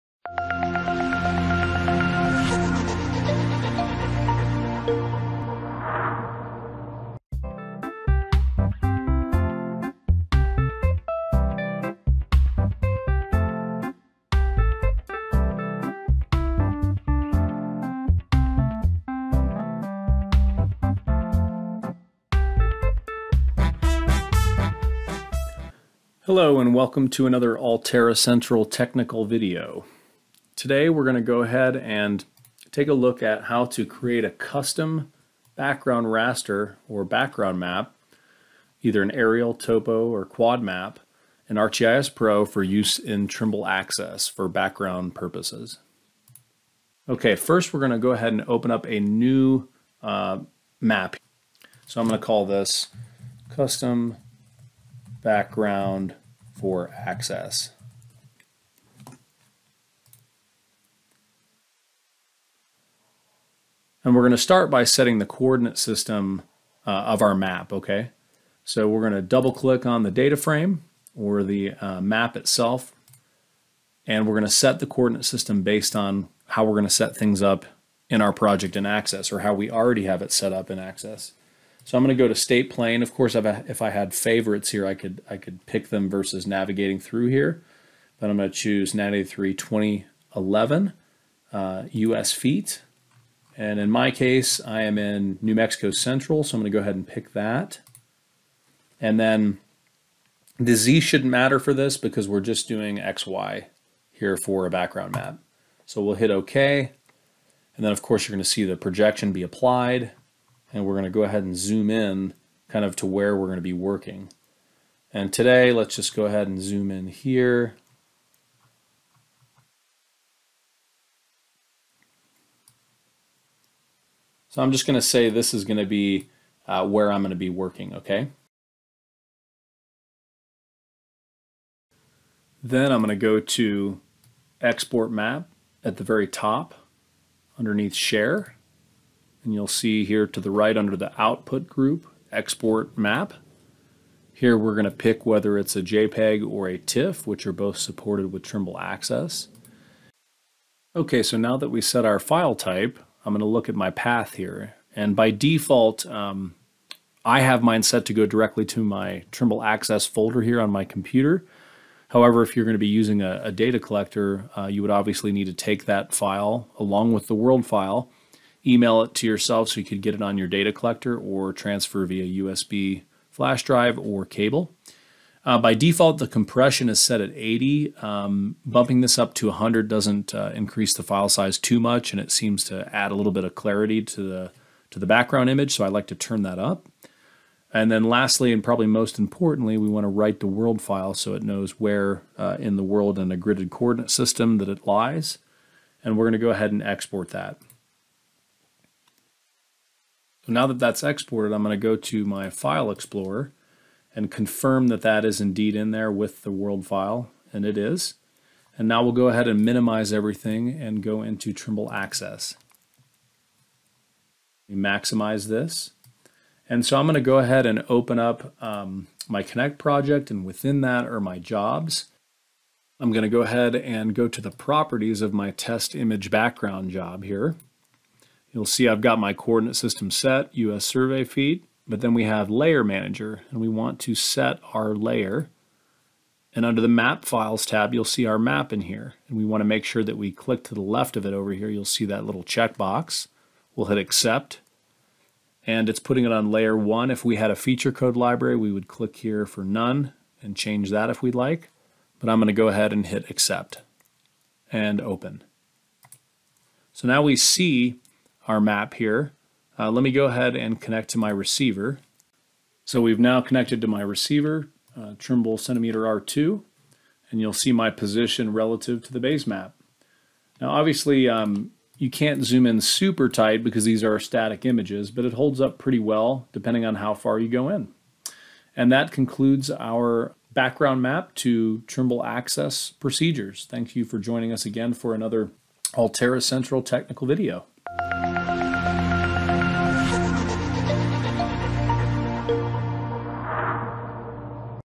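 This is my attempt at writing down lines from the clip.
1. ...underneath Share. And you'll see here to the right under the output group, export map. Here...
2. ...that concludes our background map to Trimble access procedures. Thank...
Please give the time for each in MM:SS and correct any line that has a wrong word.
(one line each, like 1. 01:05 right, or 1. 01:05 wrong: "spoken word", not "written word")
1. 02:17 right
2. 04:38 right.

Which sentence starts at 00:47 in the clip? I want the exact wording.
Okay, first we're going to go ahead and open up a new uh, map.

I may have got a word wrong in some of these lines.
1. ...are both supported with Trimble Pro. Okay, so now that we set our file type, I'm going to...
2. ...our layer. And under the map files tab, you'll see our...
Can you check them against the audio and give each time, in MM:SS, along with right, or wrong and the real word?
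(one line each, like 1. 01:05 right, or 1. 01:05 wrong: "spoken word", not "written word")
1. 02:27 wrong: "Access", not "Pro"
2. 03:54 right.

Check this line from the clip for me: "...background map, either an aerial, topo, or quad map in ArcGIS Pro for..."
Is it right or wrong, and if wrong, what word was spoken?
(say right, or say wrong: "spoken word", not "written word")
right.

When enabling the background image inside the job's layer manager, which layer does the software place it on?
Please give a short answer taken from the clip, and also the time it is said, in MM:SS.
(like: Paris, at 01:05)
Layer one, at 04:06.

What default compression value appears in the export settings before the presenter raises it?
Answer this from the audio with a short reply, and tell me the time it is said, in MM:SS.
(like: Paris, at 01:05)
80, at 02:57.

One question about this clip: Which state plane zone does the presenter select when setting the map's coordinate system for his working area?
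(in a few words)
New Mexico Central.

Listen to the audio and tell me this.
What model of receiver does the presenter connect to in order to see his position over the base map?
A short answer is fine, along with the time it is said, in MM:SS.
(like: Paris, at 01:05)
Trimble centimeter R2, at 04:25.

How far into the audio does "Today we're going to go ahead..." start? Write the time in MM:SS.
00:30.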